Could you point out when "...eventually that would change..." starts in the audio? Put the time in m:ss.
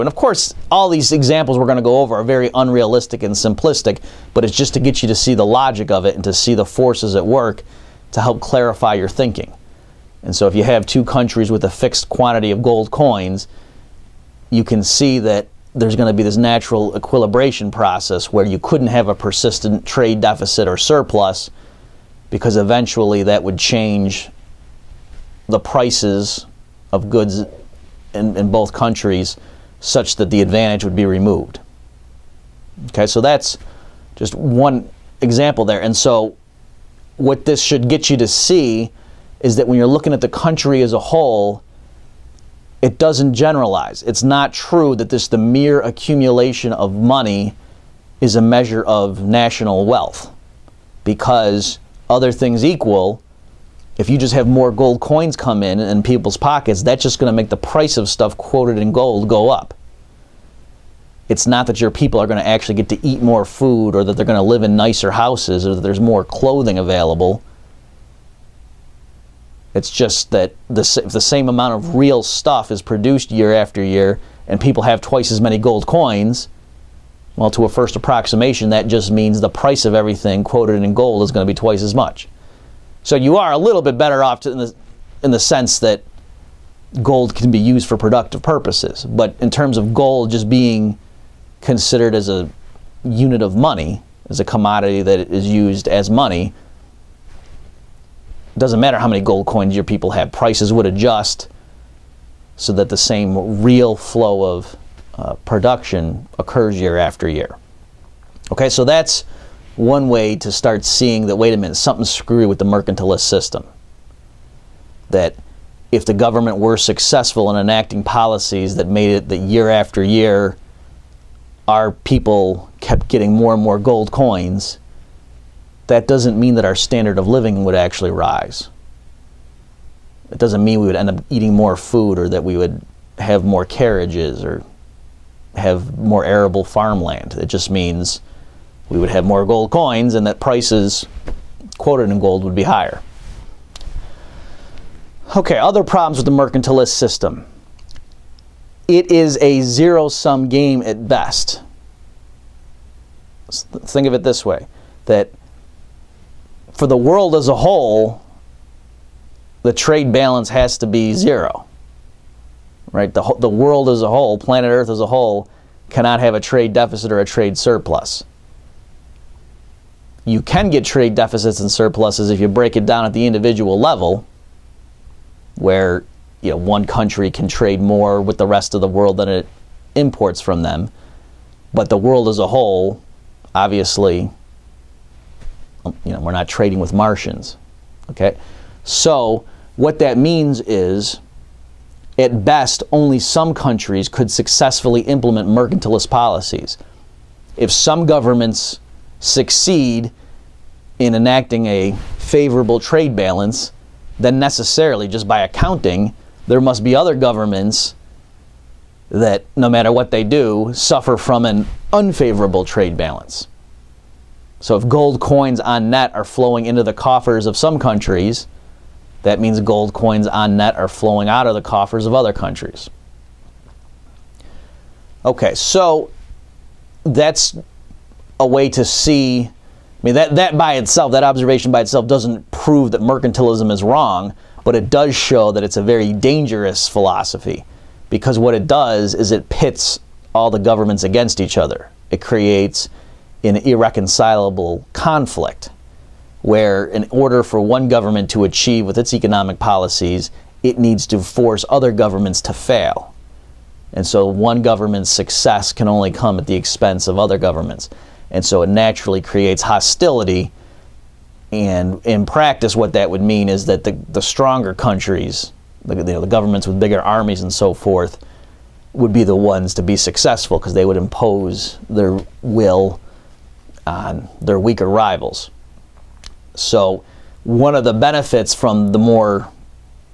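0:22.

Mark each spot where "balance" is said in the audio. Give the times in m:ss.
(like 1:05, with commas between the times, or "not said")
2:40, 3:23, 3:32.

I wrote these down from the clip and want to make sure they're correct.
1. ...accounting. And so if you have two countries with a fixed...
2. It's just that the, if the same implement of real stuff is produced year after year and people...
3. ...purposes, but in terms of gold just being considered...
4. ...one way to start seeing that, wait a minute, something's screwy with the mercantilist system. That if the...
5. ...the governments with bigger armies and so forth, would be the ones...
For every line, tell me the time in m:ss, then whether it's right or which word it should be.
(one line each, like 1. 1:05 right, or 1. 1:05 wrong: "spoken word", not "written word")
1. 0:09 wrong: "thinking", not "accounting"
2. 1:09 wrong: "amount", not "implement"
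3. 1:28 right
4. 1:49 right
5. 4:26 right.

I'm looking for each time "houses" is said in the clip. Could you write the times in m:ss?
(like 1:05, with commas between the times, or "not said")
1:05.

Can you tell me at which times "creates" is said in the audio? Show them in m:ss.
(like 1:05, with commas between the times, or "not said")
4:02, 4:19.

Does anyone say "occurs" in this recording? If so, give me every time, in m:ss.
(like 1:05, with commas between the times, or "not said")
1:46.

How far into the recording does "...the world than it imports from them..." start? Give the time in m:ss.
2:58.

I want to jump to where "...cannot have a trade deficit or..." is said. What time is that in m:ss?
2:45.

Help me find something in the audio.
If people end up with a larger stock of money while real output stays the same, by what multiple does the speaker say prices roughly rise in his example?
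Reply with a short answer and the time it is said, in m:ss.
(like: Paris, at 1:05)
Twice as much, at 1:21.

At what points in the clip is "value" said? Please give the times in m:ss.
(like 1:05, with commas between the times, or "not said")
not said.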